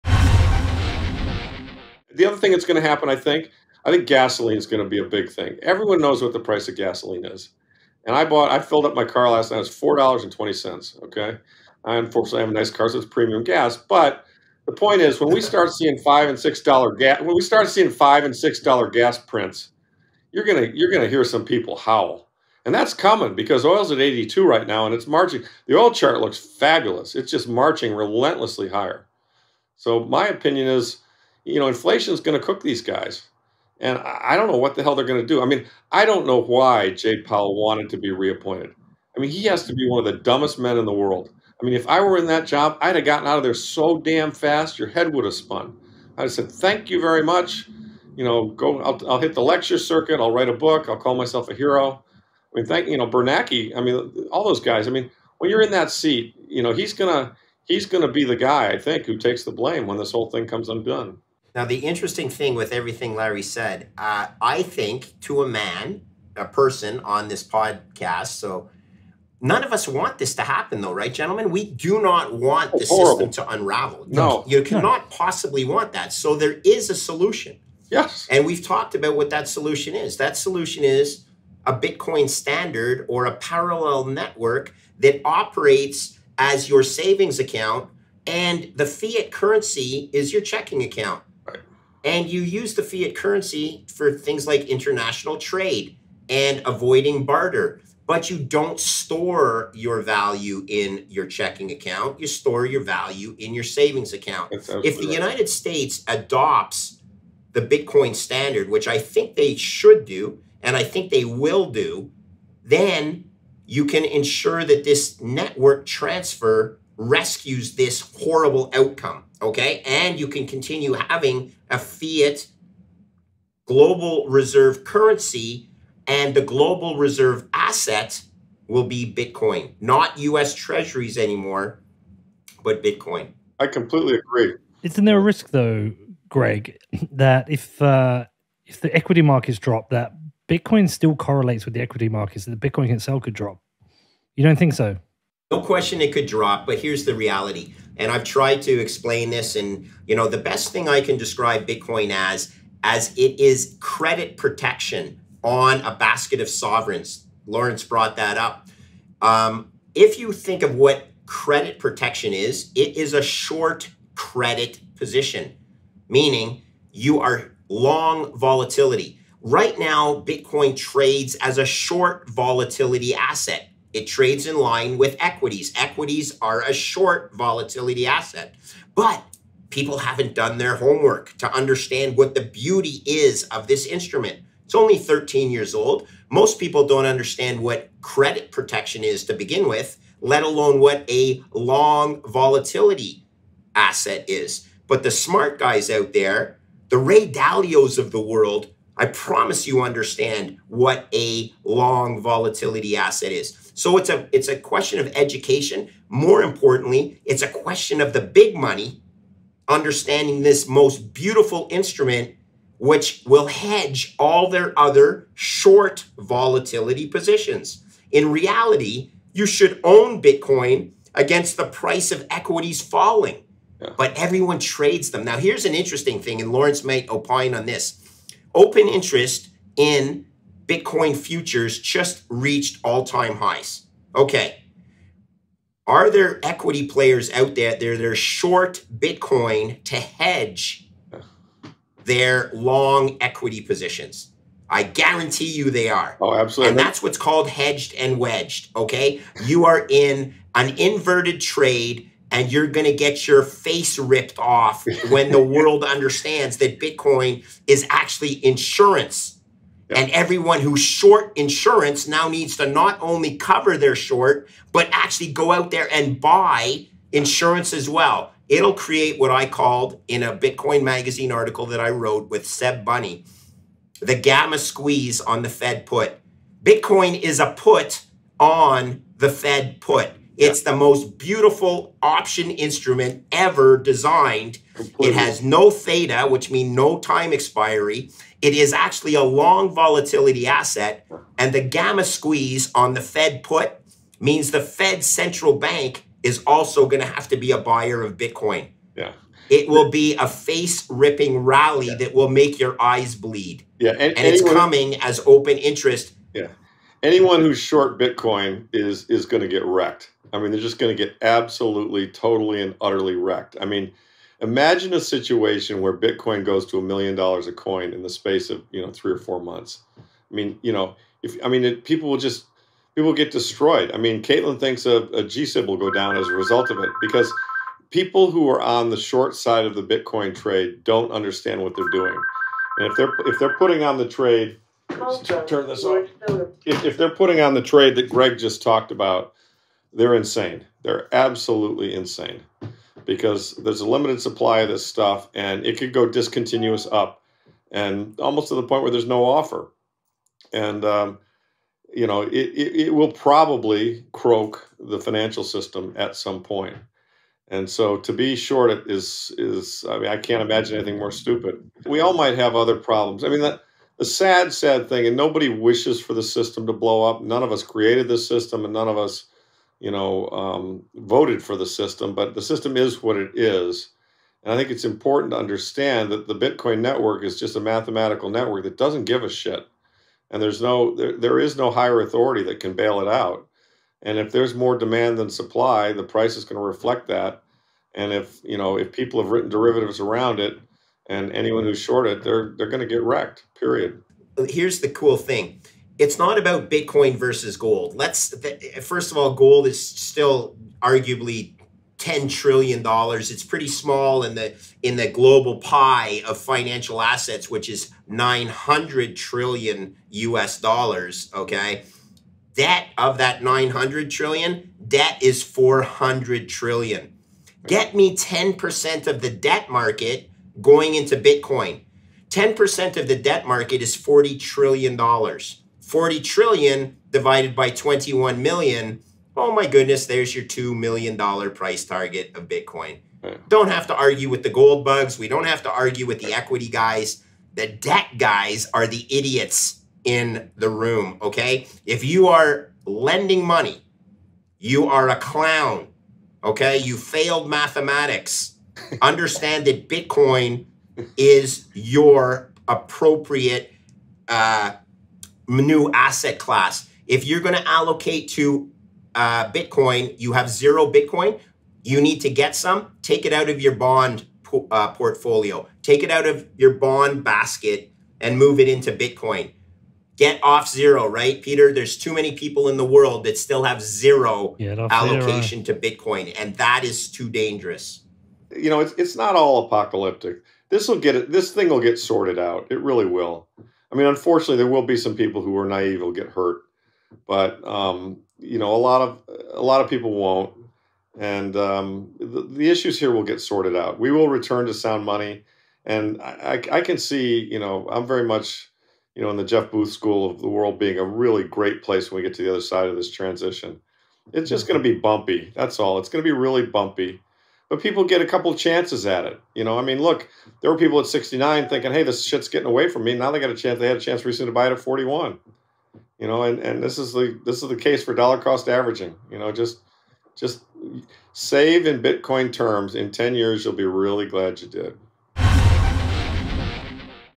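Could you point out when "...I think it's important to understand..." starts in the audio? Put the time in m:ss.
6:14.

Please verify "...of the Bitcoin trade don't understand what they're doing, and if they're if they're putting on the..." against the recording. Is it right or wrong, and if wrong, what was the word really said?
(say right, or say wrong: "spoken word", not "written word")
right.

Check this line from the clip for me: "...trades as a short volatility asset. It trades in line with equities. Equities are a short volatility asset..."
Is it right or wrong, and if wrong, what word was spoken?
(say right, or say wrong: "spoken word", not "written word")
right.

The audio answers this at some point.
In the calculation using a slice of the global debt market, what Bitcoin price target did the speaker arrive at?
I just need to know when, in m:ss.
7:10.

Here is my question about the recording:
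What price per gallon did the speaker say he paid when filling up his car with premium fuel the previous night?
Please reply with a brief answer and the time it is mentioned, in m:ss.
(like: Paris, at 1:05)
$4.20, at 0:09.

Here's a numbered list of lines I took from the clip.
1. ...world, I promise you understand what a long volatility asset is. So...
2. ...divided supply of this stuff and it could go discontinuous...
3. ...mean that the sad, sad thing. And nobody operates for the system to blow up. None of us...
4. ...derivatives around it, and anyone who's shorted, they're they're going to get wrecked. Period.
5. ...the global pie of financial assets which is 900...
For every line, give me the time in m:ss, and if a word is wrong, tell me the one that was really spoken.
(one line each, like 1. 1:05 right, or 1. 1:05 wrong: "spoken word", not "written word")
1. 3:18 right
2. 5:43 wrong: "limited", not "divided"
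3. 6:03 wrong: "wishes", not "operates"
4. 6:29 right
5. 6:44 right.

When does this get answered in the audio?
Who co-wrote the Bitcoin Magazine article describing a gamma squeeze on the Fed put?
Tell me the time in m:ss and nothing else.
4:32.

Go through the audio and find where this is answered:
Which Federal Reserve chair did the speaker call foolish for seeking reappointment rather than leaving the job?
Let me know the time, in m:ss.
0:36.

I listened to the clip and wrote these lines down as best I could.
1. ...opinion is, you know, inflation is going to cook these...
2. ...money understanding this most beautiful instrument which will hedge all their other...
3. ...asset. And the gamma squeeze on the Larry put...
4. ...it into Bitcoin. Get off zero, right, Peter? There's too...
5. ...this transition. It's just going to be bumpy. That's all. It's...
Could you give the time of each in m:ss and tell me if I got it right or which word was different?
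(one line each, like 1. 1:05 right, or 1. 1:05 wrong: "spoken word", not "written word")
1. 0:30 right
2. 3:28 right
3. 4:50 wrong: "Fed", not "Larry"
4. 7:48 right
5. 8:22 right.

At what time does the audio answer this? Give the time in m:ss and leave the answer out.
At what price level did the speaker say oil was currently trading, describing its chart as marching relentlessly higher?
0:23.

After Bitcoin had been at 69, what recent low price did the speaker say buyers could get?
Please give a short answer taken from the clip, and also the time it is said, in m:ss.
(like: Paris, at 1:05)
41, at 8:34.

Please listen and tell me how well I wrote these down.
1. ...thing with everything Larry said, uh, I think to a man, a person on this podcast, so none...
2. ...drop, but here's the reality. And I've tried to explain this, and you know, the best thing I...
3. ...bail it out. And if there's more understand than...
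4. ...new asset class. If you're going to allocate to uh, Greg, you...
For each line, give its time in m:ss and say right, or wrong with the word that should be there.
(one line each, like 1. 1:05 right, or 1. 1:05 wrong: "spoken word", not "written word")
1. 1:02 right
2. 2:26 right
3. 6:22 wrong: "demand", not "understand"
4. 7:35 wrong: "Bitcoin", not "Greg".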